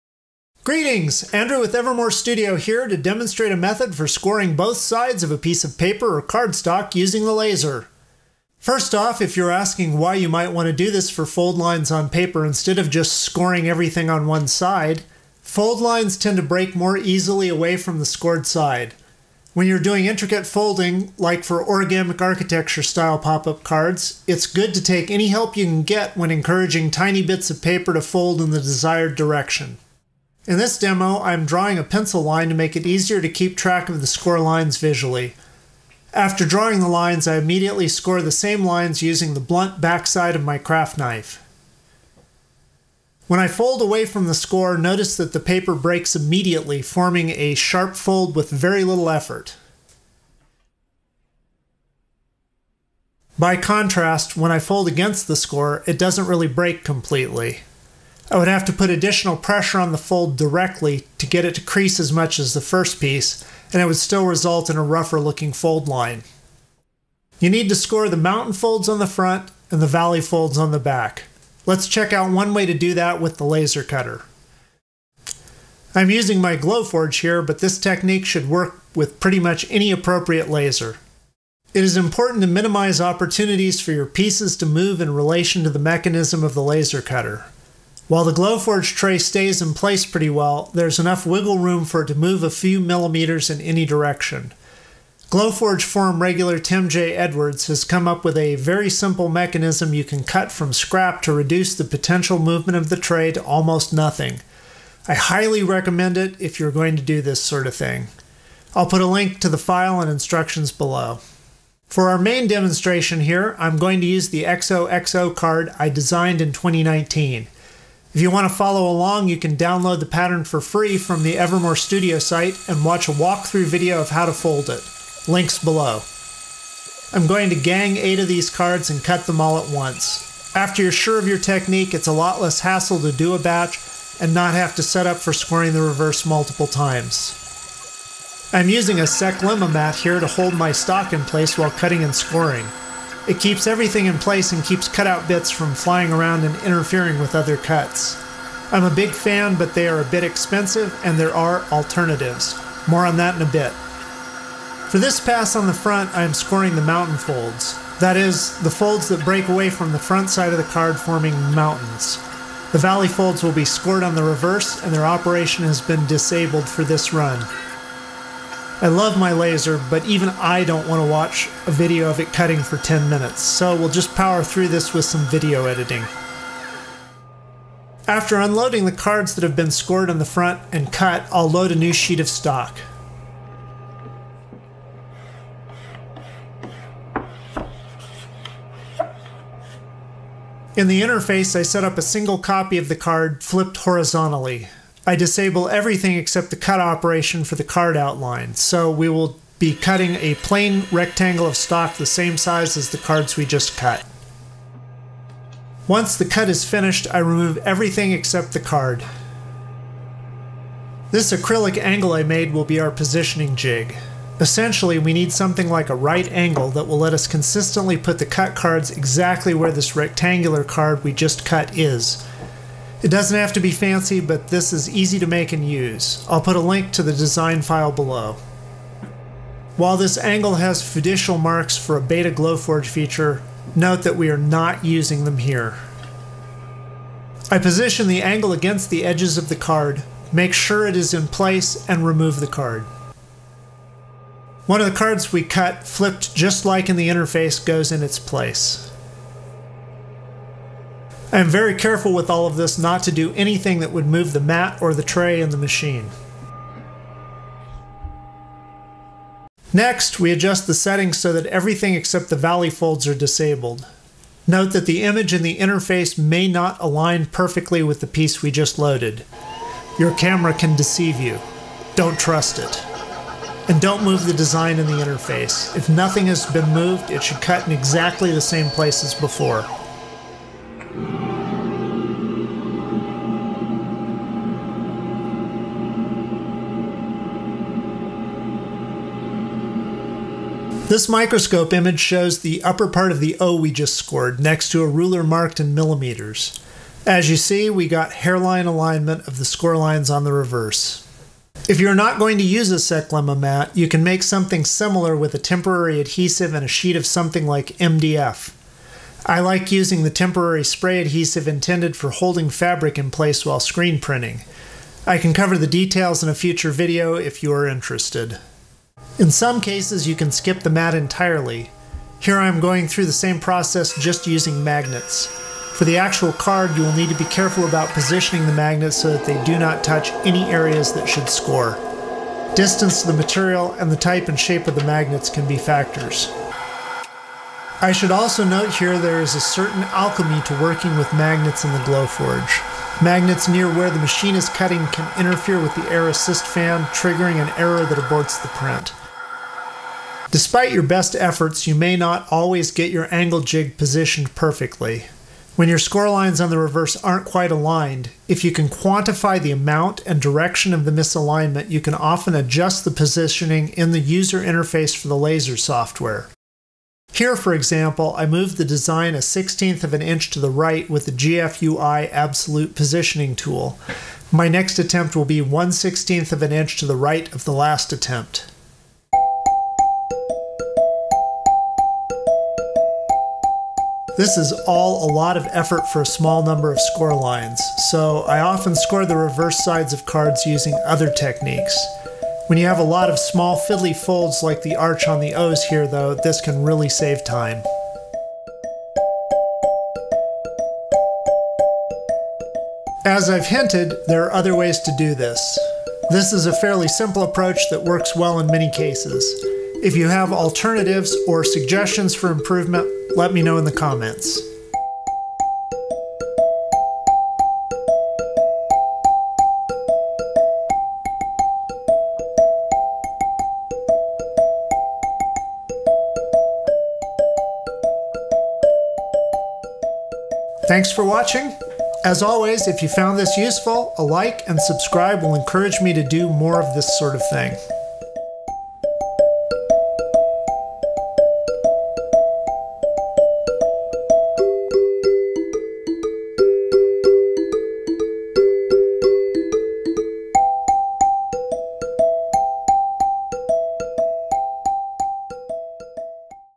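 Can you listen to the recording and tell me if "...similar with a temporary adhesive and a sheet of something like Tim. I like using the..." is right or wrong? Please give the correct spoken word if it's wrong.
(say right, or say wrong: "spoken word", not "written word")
wrong: "MDF", not "Tim".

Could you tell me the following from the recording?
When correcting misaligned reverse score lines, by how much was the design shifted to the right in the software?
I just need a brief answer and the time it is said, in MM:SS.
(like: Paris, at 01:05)
1/16 inch, at 06:09.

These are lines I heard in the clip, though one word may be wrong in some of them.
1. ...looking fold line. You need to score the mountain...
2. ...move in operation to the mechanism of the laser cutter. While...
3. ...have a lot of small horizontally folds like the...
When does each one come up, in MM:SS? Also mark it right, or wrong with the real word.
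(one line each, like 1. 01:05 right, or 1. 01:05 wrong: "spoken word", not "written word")
1. 01:05 right
2. 01:24 wrong: "relation", not "operation"
3. 06:32 wrong: "fiddly", not "horizontally".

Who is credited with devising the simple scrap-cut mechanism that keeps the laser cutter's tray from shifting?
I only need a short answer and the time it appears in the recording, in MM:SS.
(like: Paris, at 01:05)
Tim J. Edwards, at 01:36.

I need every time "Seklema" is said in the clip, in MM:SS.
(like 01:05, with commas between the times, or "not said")
02:19, 05:02.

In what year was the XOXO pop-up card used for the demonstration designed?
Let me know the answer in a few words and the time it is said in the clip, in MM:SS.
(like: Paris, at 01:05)
2019, at 01:56.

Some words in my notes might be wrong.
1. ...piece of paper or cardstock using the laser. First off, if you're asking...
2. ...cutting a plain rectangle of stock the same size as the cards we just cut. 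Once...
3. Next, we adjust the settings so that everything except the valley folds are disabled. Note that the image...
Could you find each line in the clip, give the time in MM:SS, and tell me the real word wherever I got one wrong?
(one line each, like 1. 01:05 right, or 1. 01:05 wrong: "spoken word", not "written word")
1. 00:05 right
2. 03:19 right
3. 04:19 right.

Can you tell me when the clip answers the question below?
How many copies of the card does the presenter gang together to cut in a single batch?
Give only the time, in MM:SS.
02:07.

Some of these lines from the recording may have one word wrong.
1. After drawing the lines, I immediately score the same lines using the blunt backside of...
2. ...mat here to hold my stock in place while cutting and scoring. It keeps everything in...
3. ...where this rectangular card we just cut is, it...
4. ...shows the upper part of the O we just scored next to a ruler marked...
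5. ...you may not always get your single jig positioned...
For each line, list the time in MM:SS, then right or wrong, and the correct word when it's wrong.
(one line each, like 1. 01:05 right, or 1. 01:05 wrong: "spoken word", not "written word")
1. 00:36 right
2. 02:19 right
3. 03:39 right
4. 04:52 right
5. 05:51 wrong: "angle", not "single".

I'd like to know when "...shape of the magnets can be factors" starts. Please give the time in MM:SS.
05:34.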